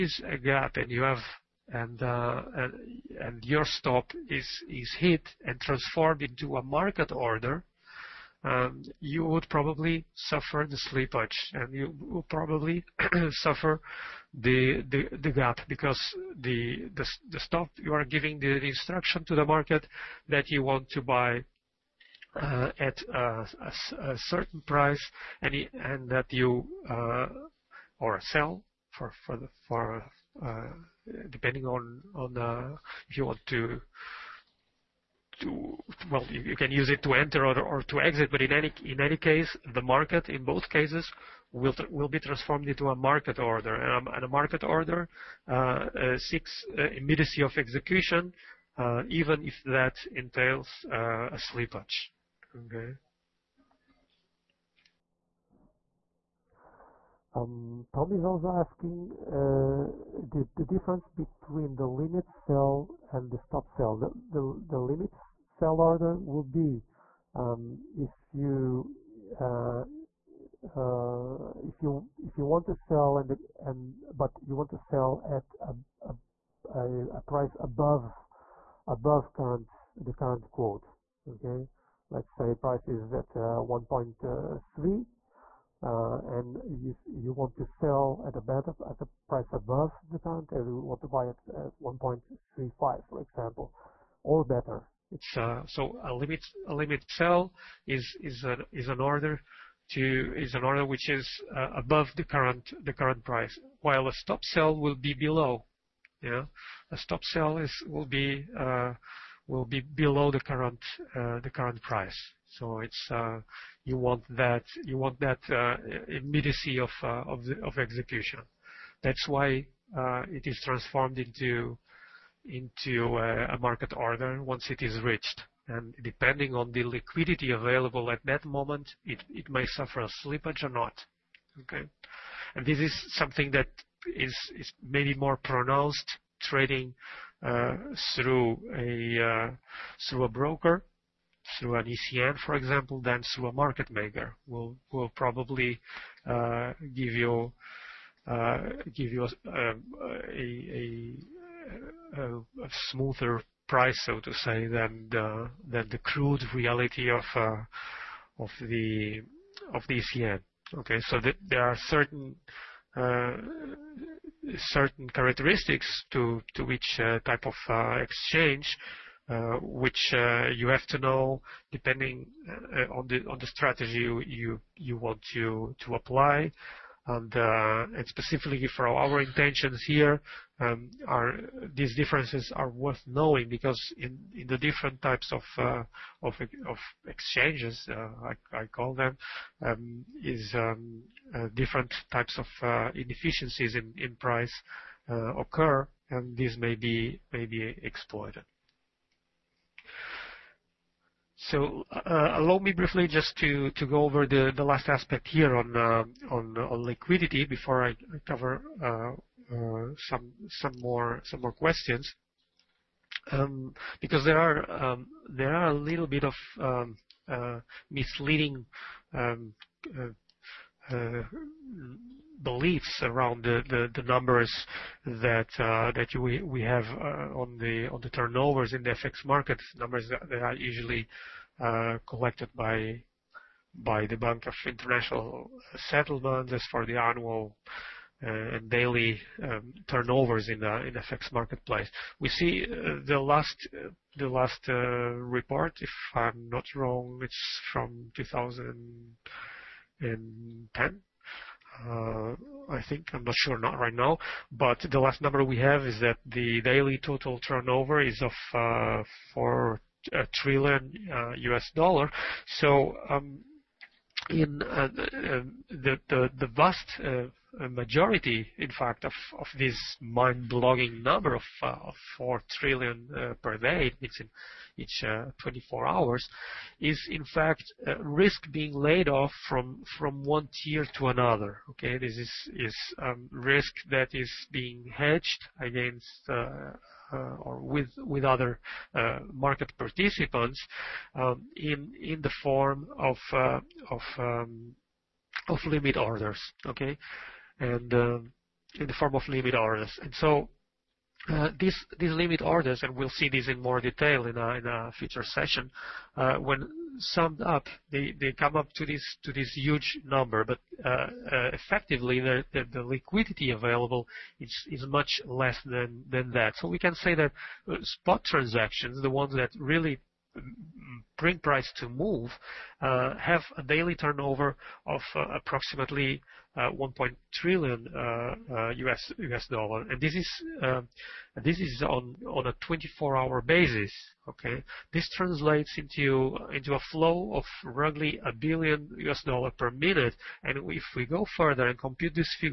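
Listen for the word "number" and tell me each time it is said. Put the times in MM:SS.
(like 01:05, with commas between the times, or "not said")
03:44, 03:49, 04:15, 04:31, 05:10.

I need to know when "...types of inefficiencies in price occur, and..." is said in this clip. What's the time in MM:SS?
03:12.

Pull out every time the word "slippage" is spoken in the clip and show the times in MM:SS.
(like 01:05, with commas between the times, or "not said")
00:10, 00:51, 02:10.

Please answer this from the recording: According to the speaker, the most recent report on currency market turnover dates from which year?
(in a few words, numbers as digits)
2010.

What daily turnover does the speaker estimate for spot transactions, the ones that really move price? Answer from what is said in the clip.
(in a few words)
1 trillion US dollars.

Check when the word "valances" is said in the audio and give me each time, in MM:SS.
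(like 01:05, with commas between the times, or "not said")
not said.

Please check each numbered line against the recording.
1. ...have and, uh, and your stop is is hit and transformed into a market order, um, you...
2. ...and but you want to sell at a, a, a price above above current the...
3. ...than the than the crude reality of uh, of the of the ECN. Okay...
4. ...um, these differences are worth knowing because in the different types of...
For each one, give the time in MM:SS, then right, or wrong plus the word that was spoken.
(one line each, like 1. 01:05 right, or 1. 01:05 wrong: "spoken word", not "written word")
1. 00:01 right
2. 01:13 right
3. 02:34 right
4. 03:00 right.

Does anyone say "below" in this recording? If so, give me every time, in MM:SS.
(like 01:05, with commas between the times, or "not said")
01:45, 01:49.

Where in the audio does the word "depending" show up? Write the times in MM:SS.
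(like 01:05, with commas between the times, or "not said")
00:31, 02:06, 02:51.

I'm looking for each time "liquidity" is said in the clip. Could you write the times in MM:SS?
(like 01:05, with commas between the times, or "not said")
02:06, 03:26, 05:12.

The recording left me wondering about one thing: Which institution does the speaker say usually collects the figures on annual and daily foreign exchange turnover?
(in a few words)
Bank of International Settlements.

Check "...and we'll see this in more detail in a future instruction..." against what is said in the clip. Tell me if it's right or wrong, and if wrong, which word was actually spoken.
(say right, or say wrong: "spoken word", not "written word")
wrong: "session", not "instruction".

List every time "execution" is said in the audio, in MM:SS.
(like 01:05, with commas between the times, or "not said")
00:47, 01:57.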